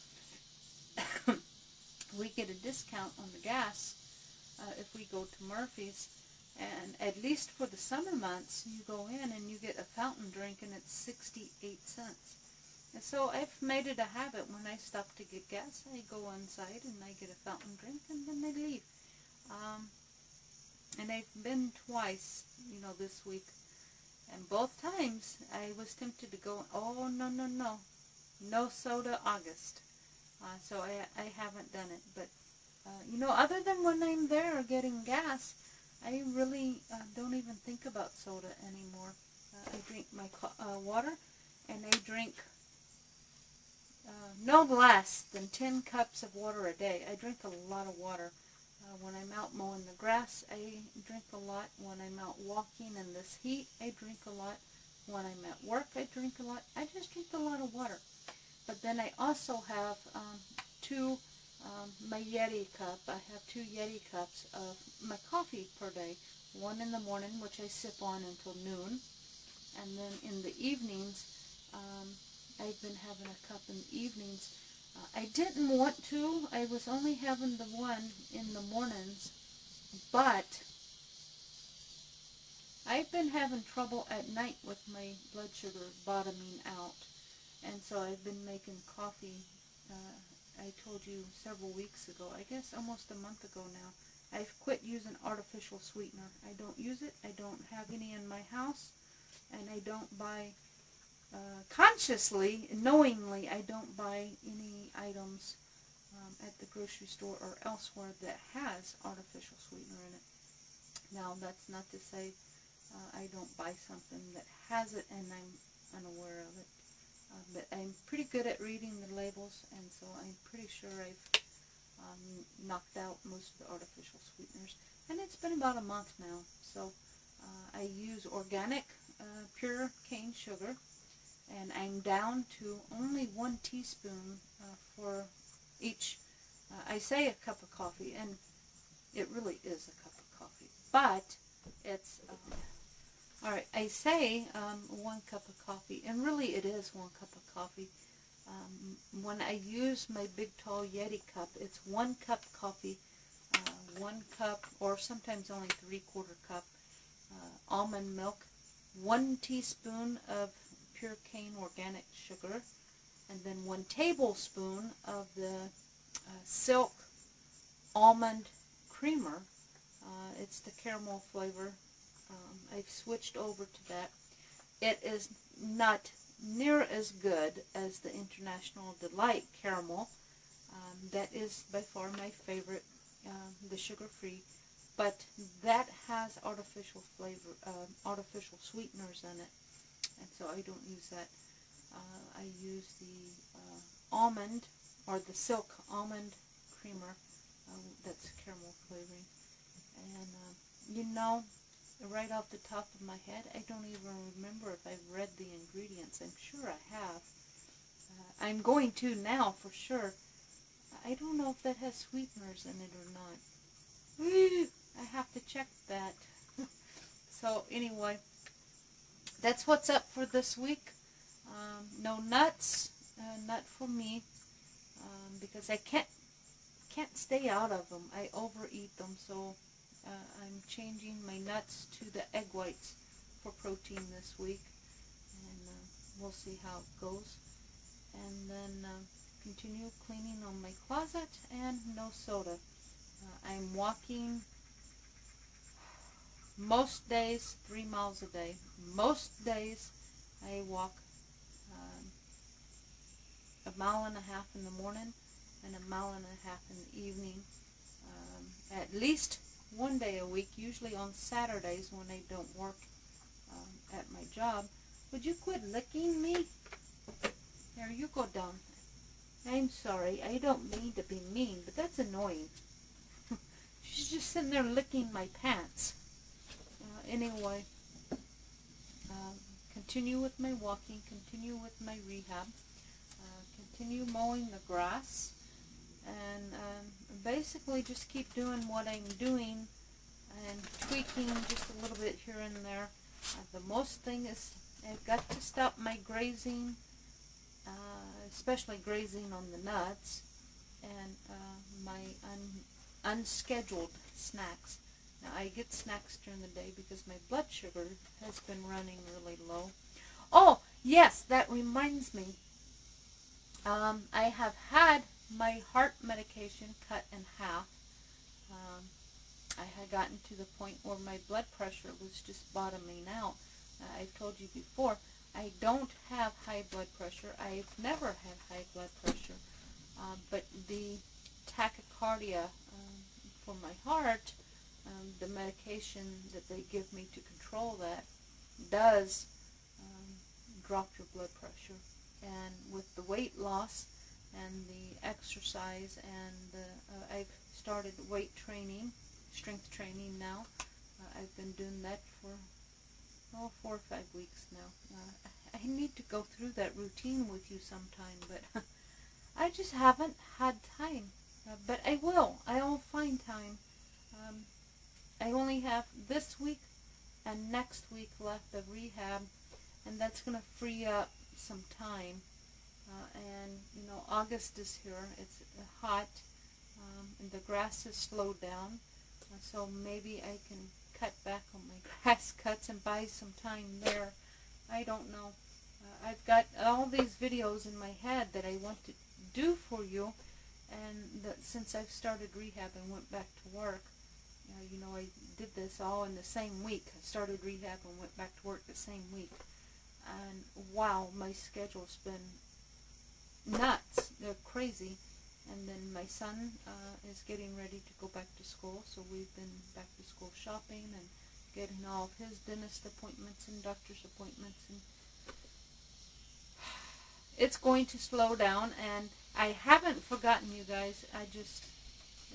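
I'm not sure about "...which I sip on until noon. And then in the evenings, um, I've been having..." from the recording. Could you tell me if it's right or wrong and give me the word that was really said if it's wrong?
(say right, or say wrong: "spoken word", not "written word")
right.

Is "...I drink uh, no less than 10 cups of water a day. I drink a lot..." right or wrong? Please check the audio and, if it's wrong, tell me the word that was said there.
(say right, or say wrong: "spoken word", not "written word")
right.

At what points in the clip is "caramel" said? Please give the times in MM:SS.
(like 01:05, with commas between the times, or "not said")
02:50, 02:59, 03:18.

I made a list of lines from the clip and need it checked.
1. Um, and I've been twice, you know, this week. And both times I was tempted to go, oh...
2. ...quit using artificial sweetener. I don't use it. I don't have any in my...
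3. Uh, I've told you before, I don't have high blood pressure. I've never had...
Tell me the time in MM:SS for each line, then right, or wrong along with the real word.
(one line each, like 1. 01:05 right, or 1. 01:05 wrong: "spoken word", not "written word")
1. 00:19 right
2. 01:34 right
3. 05:23 right.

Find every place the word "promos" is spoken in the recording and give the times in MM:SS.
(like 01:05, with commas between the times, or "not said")
not said.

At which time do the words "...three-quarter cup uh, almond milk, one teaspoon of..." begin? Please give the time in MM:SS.
02:35.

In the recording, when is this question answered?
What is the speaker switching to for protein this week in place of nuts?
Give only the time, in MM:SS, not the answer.
03:52.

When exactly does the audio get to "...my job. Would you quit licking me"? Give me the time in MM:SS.
04:24.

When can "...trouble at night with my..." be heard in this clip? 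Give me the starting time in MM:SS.
01:23.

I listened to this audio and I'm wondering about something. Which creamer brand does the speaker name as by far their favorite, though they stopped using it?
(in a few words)
International Delight.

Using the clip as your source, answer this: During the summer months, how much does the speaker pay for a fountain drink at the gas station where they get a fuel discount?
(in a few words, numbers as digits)
68 cents.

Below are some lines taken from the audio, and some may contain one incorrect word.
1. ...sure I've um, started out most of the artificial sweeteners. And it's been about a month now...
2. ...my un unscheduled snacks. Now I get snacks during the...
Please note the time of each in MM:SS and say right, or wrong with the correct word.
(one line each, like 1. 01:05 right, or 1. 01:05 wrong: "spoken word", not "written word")
1. 02:00 wrong: "knocked", not "started"
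2. 05:01 right.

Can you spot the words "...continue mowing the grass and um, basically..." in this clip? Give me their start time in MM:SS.
04:43.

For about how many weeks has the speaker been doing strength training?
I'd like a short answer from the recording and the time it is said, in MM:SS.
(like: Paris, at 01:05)
4 or 5 weeks, at 05:53.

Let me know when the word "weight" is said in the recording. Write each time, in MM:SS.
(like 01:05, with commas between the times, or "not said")
05:43, 05:48.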